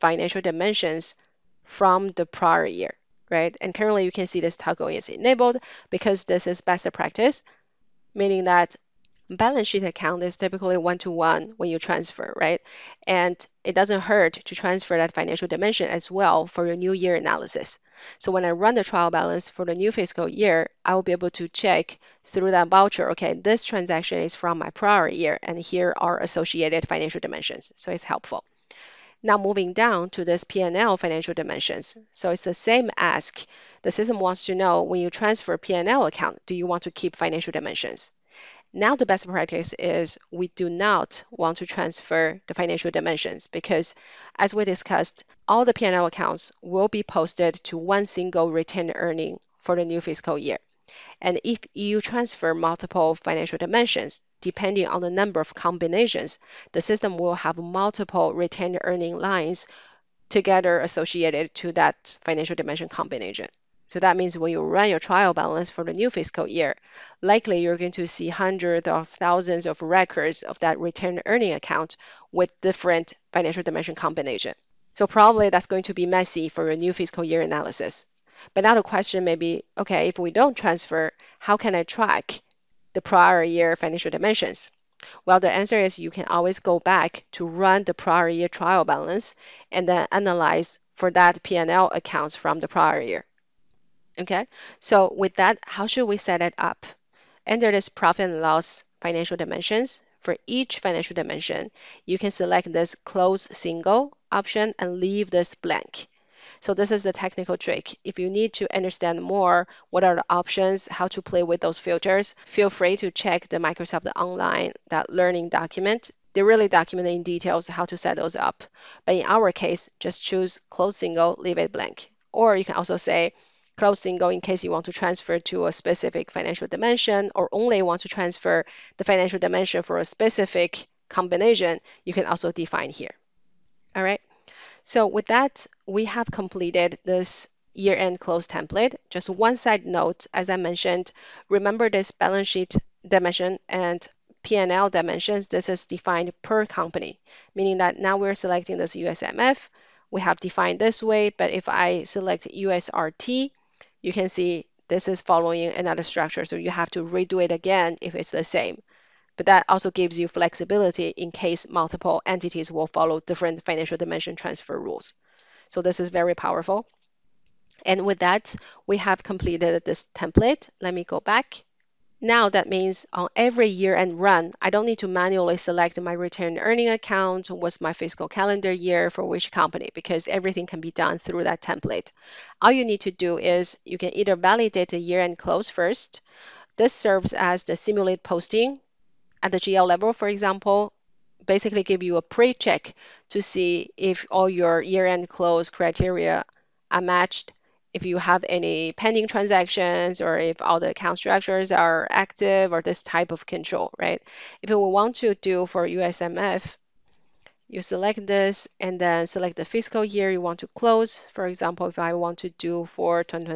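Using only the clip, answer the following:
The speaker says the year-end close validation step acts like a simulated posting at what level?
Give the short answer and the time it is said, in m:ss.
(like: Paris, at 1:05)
GL level, at 3:09.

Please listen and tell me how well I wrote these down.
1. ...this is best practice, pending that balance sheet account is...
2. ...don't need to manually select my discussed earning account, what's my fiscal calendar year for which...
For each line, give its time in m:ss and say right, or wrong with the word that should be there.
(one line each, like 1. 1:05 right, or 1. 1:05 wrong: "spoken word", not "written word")
1. 0:06 wrong: "meaning", not "pending"
2. 2:54 wrong: "retained", not "discussed".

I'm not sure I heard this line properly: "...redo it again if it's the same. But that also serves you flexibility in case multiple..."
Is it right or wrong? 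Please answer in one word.
wrong.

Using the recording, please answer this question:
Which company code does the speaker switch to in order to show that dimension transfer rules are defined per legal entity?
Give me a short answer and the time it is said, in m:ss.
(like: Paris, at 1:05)
USRT, at 2:32.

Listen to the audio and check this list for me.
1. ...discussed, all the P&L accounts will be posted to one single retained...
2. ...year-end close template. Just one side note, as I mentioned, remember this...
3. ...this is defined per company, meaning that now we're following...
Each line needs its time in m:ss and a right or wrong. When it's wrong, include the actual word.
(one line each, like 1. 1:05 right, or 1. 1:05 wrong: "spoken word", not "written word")
1. 0:44 right
2. 2:17 right
3. 2:25 wrong: "selecting", not "following".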